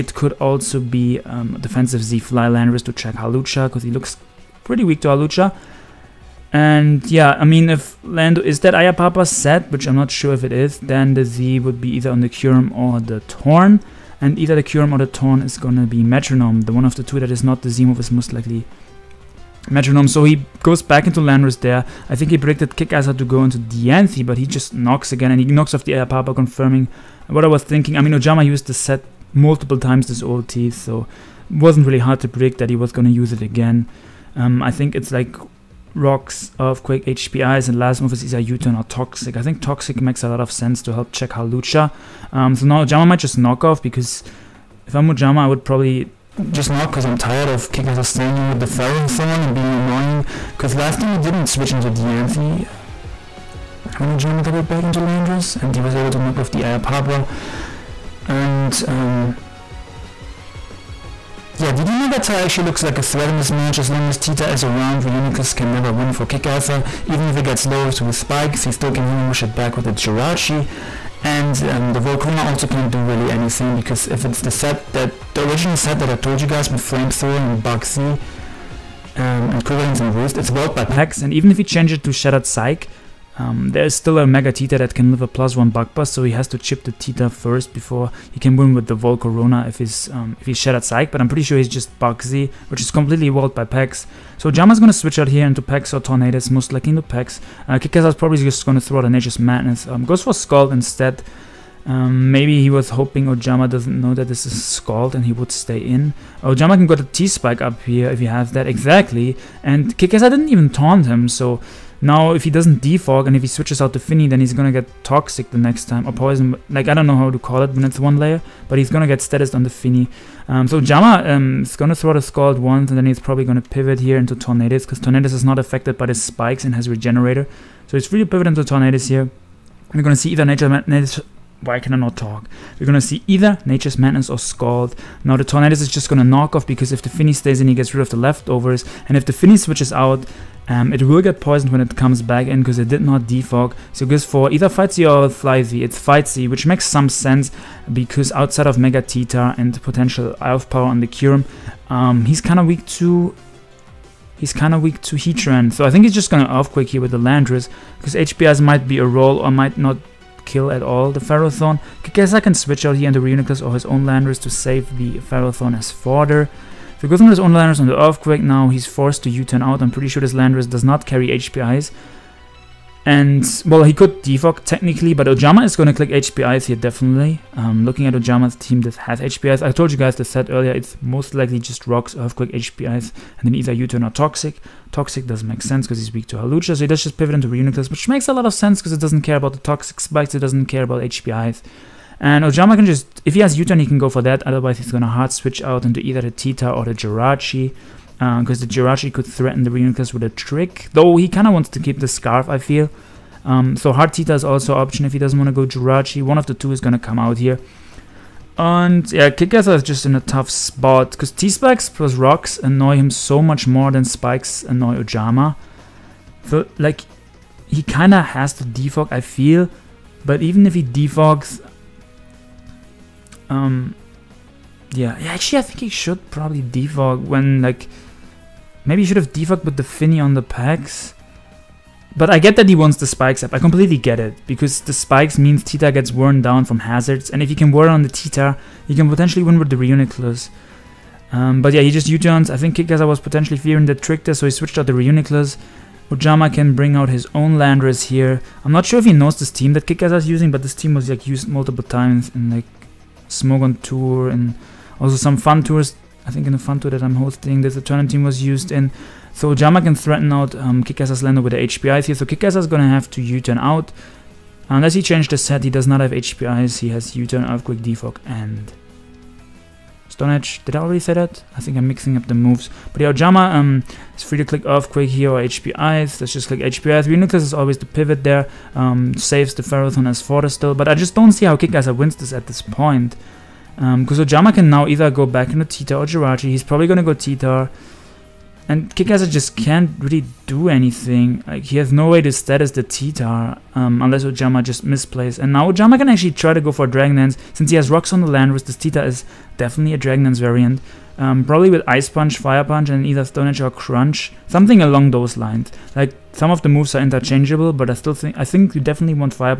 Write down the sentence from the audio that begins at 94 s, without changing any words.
So Jama's gonna switch out here into Pex or Tornadus, most likely into Pex.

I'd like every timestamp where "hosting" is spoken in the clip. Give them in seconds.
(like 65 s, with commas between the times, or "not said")
257 s.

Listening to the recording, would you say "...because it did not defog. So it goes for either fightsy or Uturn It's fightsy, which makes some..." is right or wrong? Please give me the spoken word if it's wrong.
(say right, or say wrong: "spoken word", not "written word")
wrong: "Fly", not "Uturn".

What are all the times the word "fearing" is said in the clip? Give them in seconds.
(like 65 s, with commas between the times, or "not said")
243 s.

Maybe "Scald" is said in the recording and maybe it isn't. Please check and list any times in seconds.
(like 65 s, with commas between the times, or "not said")
100 s, 104 s, 122 s, 134 s.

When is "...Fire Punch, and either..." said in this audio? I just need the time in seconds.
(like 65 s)
302 s.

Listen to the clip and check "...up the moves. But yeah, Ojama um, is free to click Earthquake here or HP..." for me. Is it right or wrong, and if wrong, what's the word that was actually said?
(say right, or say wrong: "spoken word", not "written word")
right.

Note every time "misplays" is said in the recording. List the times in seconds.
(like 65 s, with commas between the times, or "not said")
294 s.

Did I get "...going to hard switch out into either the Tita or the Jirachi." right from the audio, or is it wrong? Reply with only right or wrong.
right.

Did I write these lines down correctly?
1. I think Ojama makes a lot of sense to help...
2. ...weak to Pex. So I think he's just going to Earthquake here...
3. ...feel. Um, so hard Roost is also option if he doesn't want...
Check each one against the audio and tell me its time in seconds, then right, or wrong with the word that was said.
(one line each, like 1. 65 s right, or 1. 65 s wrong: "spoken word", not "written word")
1. 39 s wrong: "Toxic", not "Ojama"
2. 154 s wrong: "Heatran", not "Pex"
3. 202 s wrong: "Tita", not "Roost".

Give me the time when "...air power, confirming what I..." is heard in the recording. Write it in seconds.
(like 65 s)
25 s.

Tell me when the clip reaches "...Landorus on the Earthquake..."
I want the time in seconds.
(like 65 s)
167 s.